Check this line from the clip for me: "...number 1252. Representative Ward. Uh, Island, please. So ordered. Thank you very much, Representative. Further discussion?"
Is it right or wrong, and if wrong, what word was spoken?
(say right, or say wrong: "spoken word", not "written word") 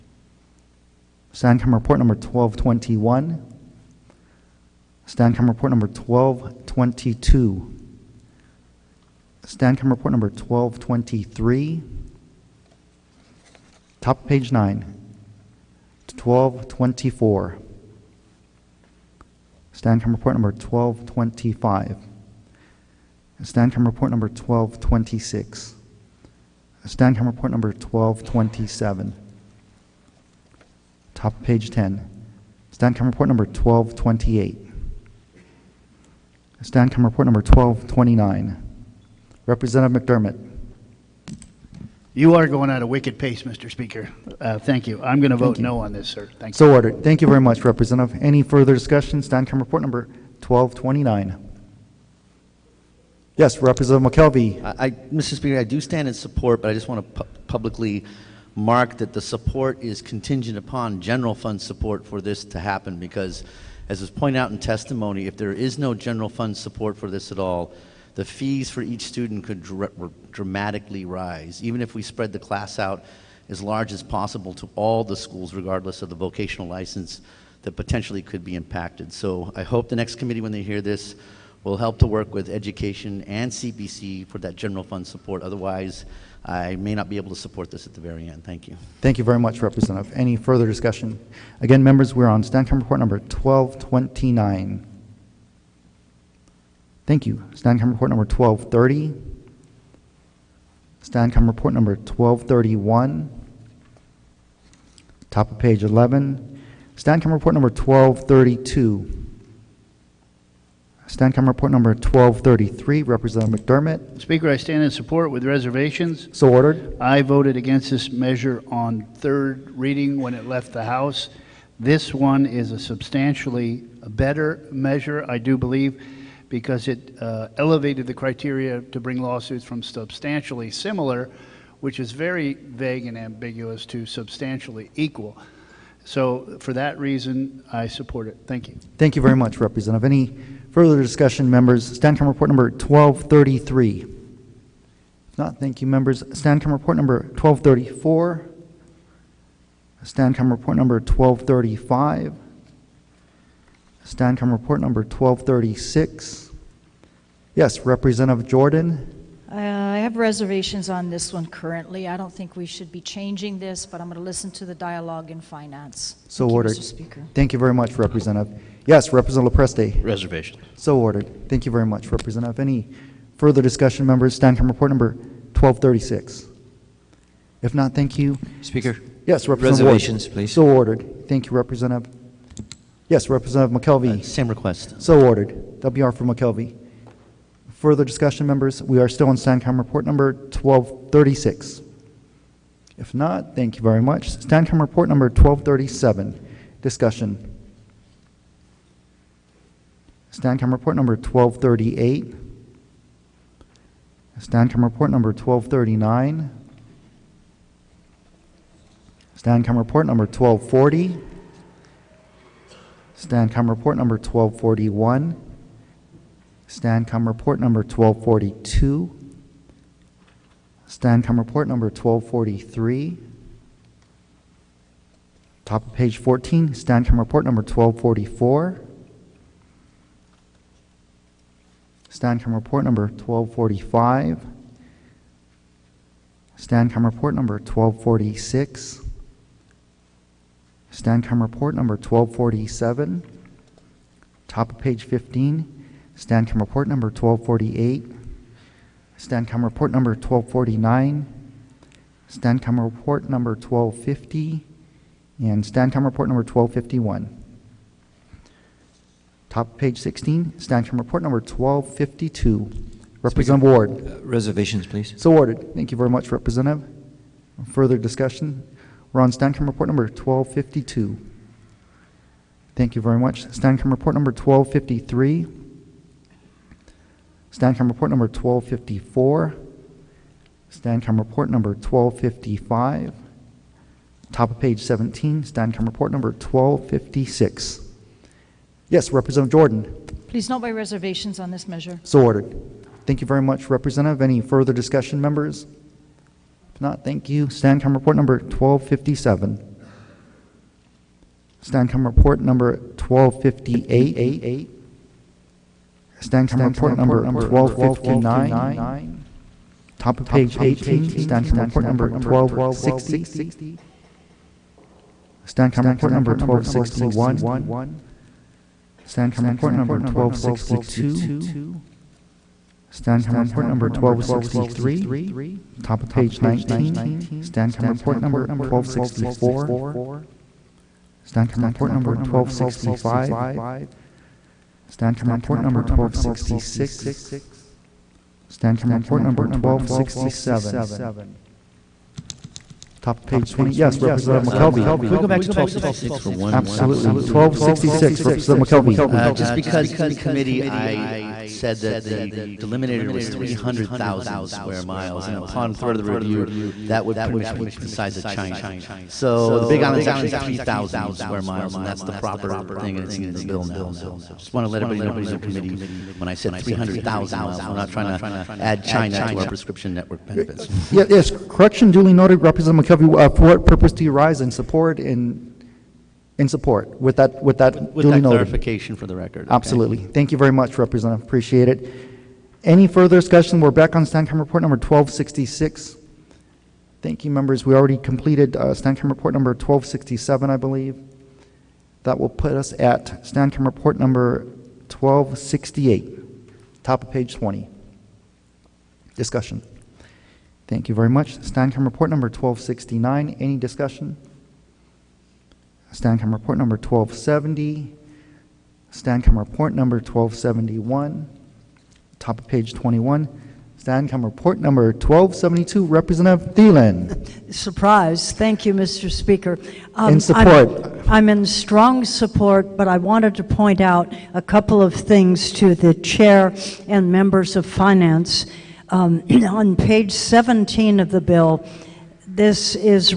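wrong: "Reservations", not "Island".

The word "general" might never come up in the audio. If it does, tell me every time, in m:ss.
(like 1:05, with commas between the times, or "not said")
1:01, 1:05, 1:24.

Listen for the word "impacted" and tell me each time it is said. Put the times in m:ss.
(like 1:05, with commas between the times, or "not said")
1:18.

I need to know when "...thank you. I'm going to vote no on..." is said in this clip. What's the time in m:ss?
0:44.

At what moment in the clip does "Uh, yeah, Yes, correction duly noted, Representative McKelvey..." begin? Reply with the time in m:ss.
6:10.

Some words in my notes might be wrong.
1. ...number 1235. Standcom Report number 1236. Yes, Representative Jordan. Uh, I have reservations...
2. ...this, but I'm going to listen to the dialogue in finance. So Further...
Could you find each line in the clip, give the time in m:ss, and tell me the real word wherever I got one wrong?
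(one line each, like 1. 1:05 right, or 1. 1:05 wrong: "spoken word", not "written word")
1. 2:30 right
2. 2:43 wrong: "Thank", not "Further".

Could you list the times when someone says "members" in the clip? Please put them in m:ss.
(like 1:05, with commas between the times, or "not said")
1:31, 2:21, 2:25, 2:54, 3:08, 4:55, 6:27, 7:07.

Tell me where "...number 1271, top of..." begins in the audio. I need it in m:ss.
6:49.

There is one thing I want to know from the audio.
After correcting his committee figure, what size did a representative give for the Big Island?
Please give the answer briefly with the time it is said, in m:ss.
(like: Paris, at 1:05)
3,000 square miles, at 6:00.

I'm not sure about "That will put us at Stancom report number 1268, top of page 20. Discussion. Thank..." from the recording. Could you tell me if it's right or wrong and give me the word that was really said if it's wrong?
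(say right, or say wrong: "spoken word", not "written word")
right.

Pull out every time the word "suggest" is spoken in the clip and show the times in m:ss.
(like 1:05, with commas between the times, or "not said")
not said.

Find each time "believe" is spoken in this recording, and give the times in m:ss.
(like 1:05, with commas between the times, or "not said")
2:05, 6:30.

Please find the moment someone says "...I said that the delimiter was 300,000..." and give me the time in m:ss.
5:50.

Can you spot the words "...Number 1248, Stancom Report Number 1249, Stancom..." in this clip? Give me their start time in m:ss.
4:06.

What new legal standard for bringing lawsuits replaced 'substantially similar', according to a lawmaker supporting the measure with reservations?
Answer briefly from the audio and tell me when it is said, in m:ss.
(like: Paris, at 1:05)
substantially equal, at 2:14.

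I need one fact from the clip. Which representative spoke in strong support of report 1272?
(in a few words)
Thielen.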